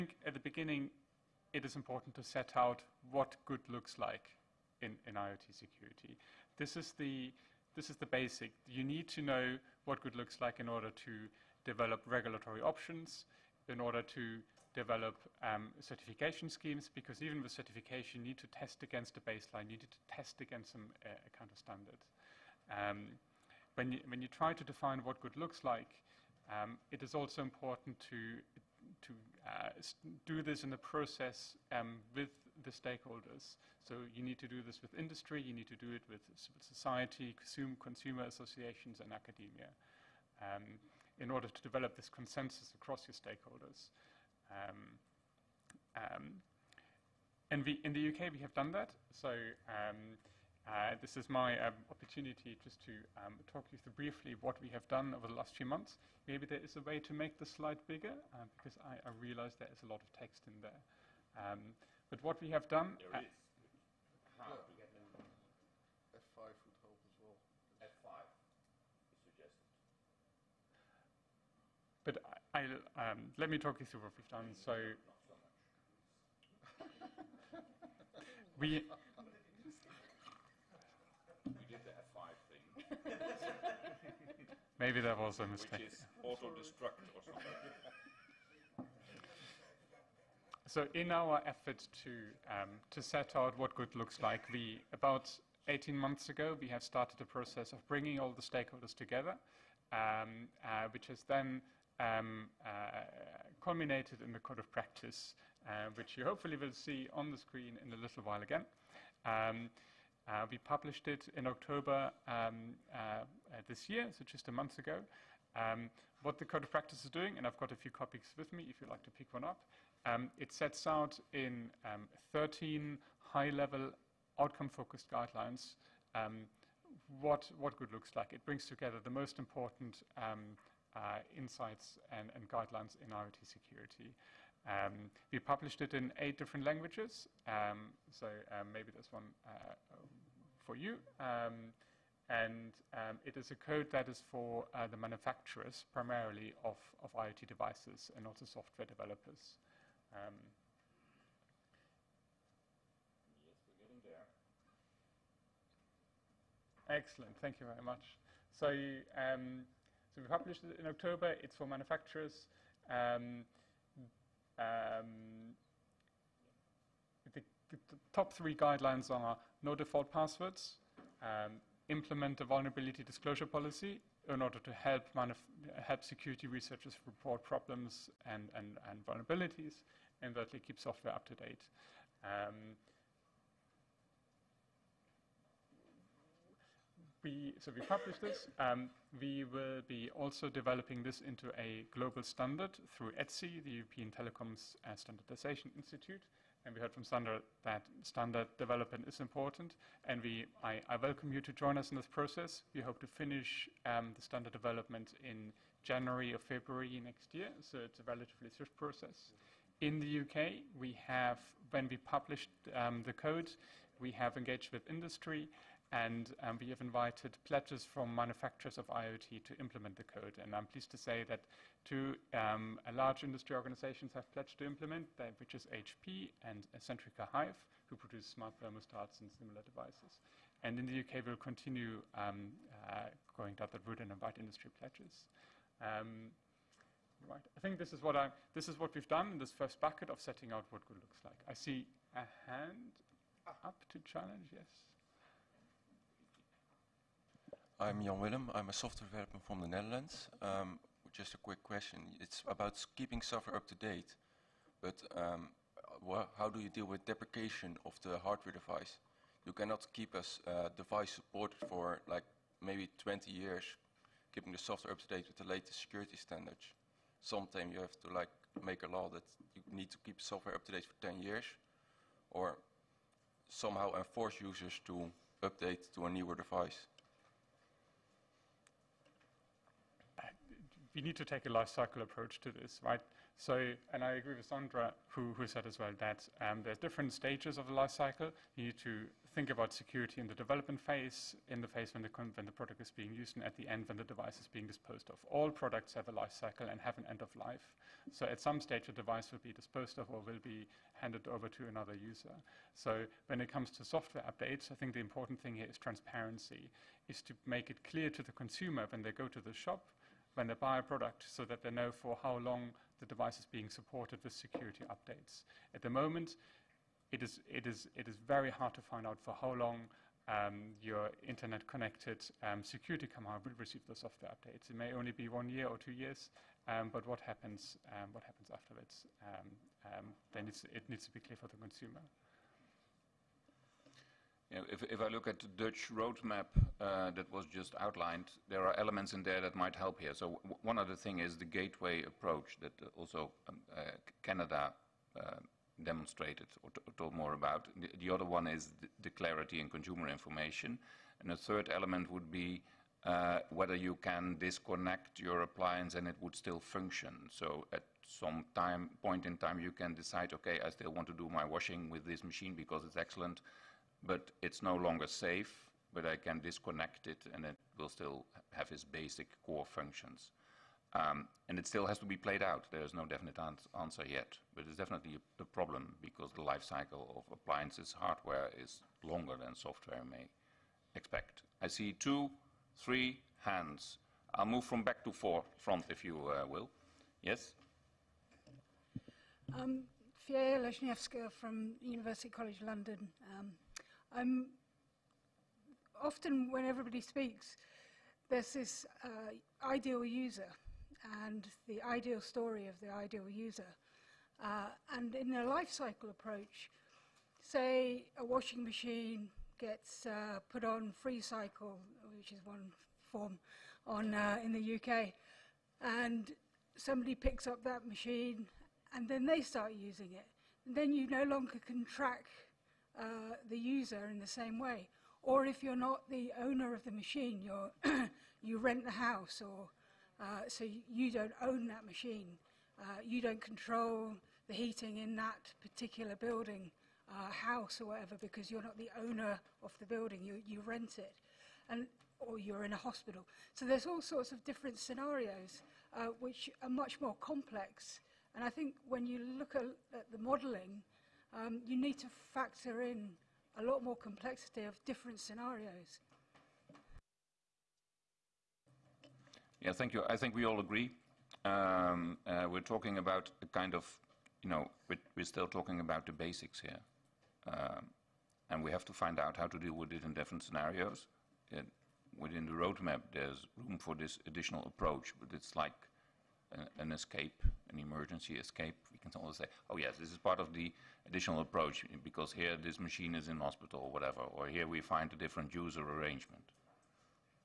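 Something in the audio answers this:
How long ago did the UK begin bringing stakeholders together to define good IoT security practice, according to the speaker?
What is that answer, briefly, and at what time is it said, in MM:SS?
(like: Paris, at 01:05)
18 months, at 01:35.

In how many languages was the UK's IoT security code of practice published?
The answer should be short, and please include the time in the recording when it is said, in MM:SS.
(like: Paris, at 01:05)
8, at 02:16.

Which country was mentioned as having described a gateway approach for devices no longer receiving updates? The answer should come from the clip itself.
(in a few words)
Canada.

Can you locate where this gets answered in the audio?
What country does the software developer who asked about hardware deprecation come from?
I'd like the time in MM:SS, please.
04:09.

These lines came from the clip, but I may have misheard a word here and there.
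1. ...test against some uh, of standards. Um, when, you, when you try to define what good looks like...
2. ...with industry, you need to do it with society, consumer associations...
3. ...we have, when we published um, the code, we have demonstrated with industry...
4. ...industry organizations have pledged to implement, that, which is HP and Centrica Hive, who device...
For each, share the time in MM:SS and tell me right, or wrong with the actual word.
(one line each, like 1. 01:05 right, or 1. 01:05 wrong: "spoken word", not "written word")
1. 00:20 right
2. 00:34 right
3. 03:30 wrong: "engaged", not "demonstrated"
4. 03:43 wrong: "produce", not "device".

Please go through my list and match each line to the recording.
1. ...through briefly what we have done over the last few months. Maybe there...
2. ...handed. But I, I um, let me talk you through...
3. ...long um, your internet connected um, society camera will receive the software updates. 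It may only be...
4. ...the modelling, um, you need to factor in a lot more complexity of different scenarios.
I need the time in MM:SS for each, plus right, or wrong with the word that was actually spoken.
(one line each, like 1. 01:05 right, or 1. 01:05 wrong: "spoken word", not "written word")
1. 00:53 right
2. 01:09 wrong: "suggested", not "handed"
3. 05:19 wrong: "security", not "society"
4. 07:30 right.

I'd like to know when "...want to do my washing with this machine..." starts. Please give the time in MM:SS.
06:00.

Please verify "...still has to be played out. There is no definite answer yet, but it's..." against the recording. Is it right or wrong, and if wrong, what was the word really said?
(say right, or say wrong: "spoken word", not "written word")
right.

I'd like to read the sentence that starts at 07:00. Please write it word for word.
And then you no longer can track uh, the user in the same way.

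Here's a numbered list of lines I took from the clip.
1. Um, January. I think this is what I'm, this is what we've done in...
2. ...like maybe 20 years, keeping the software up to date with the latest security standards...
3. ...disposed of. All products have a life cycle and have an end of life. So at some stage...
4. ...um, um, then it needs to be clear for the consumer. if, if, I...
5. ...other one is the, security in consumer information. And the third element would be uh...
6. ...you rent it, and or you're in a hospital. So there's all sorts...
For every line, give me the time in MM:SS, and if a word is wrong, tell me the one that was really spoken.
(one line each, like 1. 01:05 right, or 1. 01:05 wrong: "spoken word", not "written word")
1. 03:55 wrong: "Right", not "January"
2. 04:22 right
3. 04:54 right
4. 05:29 right
5. 05:48 wrong: "clarity", not "security"
6. 07:20 right.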